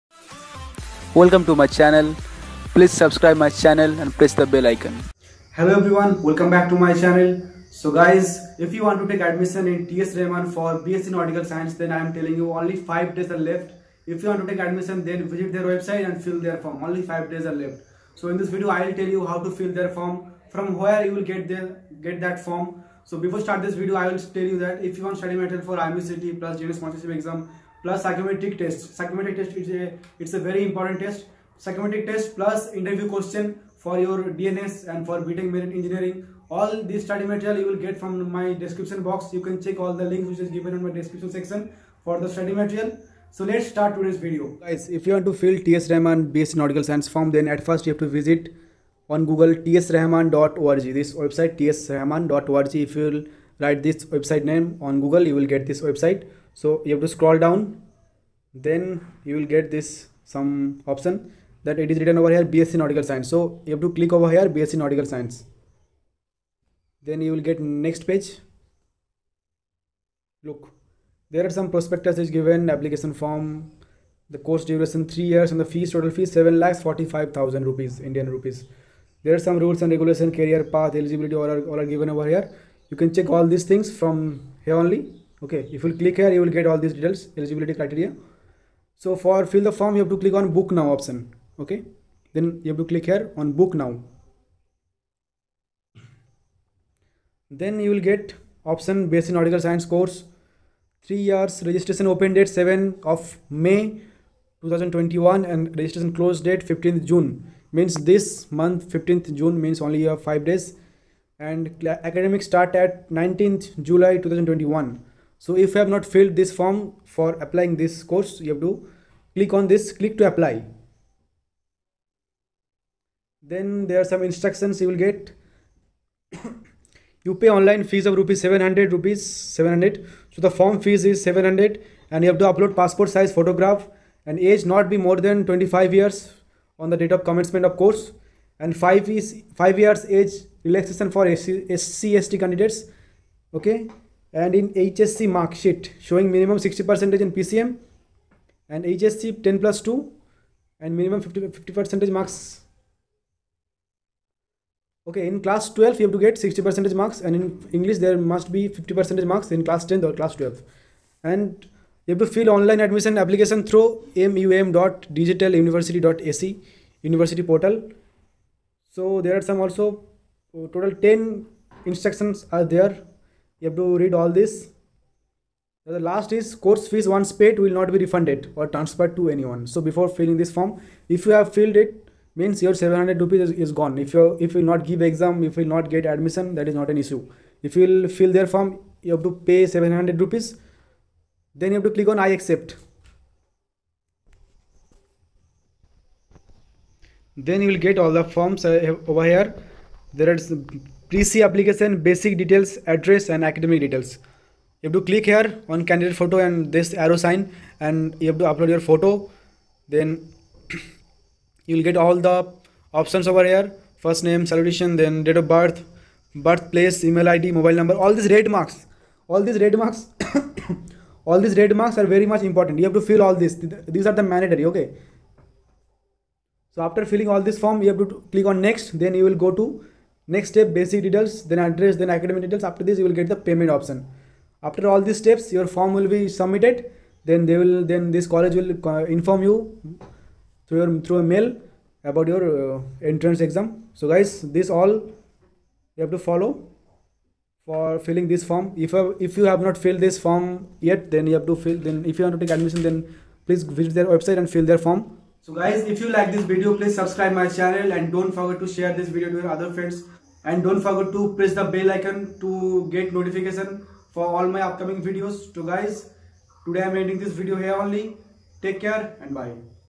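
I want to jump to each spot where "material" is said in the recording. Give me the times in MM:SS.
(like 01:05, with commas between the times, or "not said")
00:25, 00:37, 00:42.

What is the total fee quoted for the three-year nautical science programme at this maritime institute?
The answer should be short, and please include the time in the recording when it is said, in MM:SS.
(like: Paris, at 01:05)
7 lakhs 45000 rupees, at 01:16.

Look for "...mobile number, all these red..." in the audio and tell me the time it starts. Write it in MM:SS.
03:37.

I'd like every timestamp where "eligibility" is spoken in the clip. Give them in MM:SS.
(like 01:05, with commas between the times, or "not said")
01:20, 01:27.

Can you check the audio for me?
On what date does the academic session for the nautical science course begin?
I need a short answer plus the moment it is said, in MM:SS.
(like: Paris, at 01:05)
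19th July 2021, at 01:53.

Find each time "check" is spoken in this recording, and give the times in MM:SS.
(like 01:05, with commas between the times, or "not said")
00:39, 01:23.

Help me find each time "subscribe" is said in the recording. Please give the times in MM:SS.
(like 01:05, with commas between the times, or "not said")
00:02, 04:16.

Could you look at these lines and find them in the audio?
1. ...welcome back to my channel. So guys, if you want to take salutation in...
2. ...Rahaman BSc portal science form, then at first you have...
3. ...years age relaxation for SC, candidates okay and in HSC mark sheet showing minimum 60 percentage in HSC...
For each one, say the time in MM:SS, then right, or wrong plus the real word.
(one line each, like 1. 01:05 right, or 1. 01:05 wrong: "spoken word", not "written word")
1. 00:06 wrong: "admission", not "salutation"
2. 00:45 wrong: "nautical", not "portal"
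3. 02:19 wrong: "PCM", not "HSC".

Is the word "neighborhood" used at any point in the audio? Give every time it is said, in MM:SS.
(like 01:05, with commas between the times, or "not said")
not said.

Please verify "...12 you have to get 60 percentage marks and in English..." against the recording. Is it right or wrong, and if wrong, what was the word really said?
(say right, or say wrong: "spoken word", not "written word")
right.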